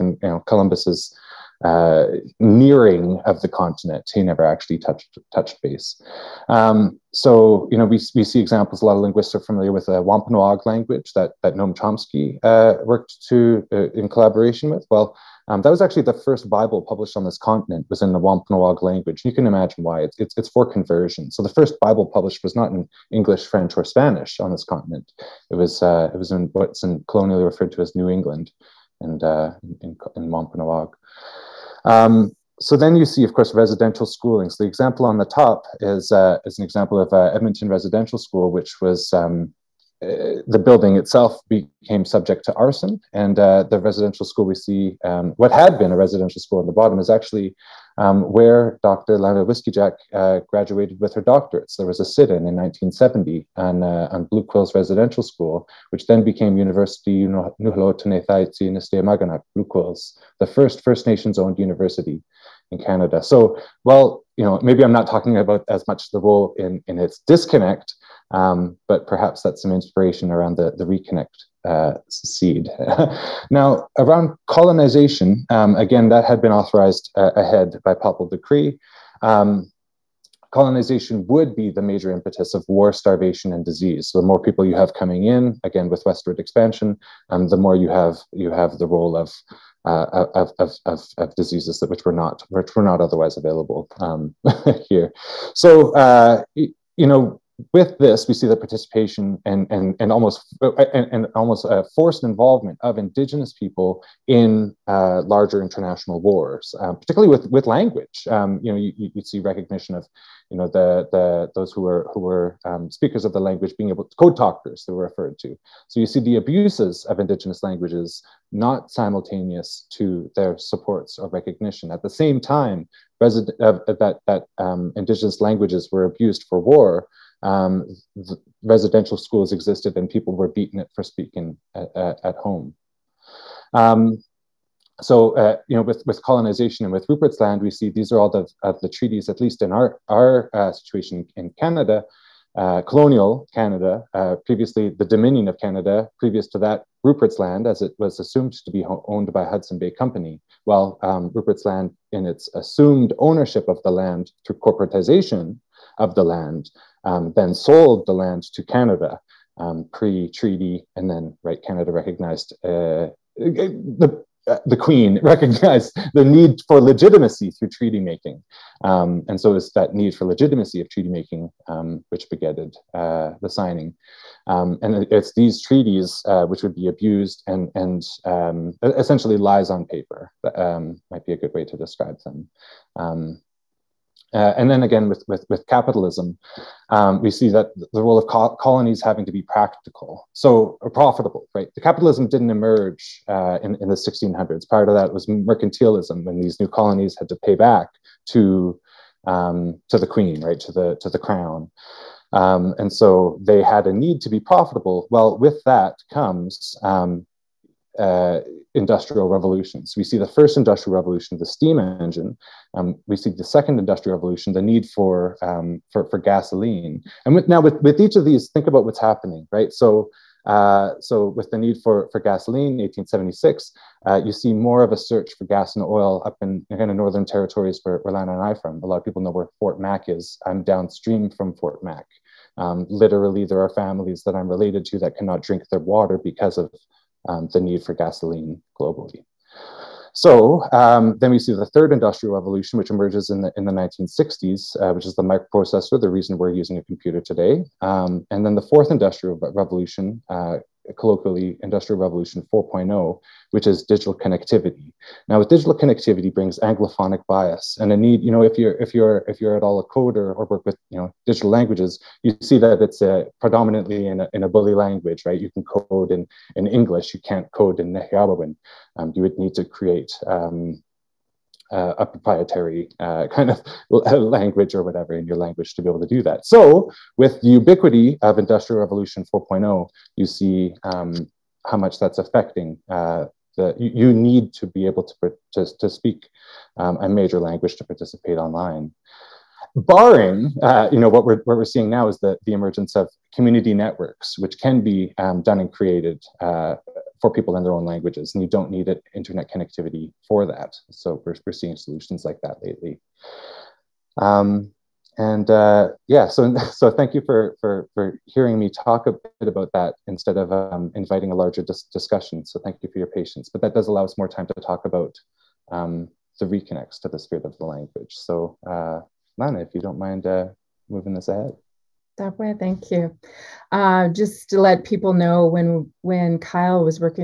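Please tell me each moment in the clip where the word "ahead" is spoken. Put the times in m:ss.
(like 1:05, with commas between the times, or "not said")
1:17, 5:21.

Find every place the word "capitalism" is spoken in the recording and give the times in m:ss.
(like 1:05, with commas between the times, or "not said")
3:05, 3:11.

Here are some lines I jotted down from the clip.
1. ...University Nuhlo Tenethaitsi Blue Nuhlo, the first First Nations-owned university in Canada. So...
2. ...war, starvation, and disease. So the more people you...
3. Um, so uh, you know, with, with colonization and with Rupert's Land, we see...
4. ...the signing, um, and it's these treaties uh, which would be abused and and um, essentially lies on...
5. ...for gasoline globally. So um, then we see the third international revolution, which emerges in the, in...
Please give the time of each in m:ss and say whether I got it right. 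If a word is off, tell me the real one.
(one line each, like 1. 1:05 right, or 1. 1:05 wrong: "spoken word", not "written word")
1. 0:56 wrong: "Quills", not "Nuhlo"
2. 1:22 right
3. 2:13 right
4. 2:53 right
5. 3:57 wrong: "industrial", not "international".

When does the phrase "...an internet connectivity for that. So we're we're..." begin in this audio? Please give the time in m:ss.
4:58.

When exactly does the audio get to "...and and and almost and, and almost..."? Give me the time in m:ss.
1:39.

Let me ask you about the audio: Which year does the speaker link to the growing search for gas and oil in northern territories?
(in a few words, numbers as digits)
1876.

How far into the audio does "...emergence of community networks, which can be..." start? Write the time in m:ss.
4:52.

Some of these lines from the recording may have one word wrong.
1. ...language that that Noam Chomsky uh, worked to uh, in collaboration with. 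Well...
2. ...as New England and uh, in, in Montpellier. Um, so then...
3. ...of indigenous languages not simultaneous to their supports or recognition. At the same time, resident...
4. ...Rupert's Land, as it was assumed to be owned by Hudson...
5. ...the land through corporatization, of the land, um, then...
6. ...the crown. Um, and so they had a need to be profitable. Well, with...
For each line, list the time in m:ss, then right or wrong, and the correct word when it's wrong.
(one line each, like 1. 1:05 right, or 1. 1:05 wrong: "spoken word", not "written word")
1. 0:10 right
2. 0:27 right
3. 1:57 right
4. 2:27 right
5. 2:33 right
6. 3:21 right.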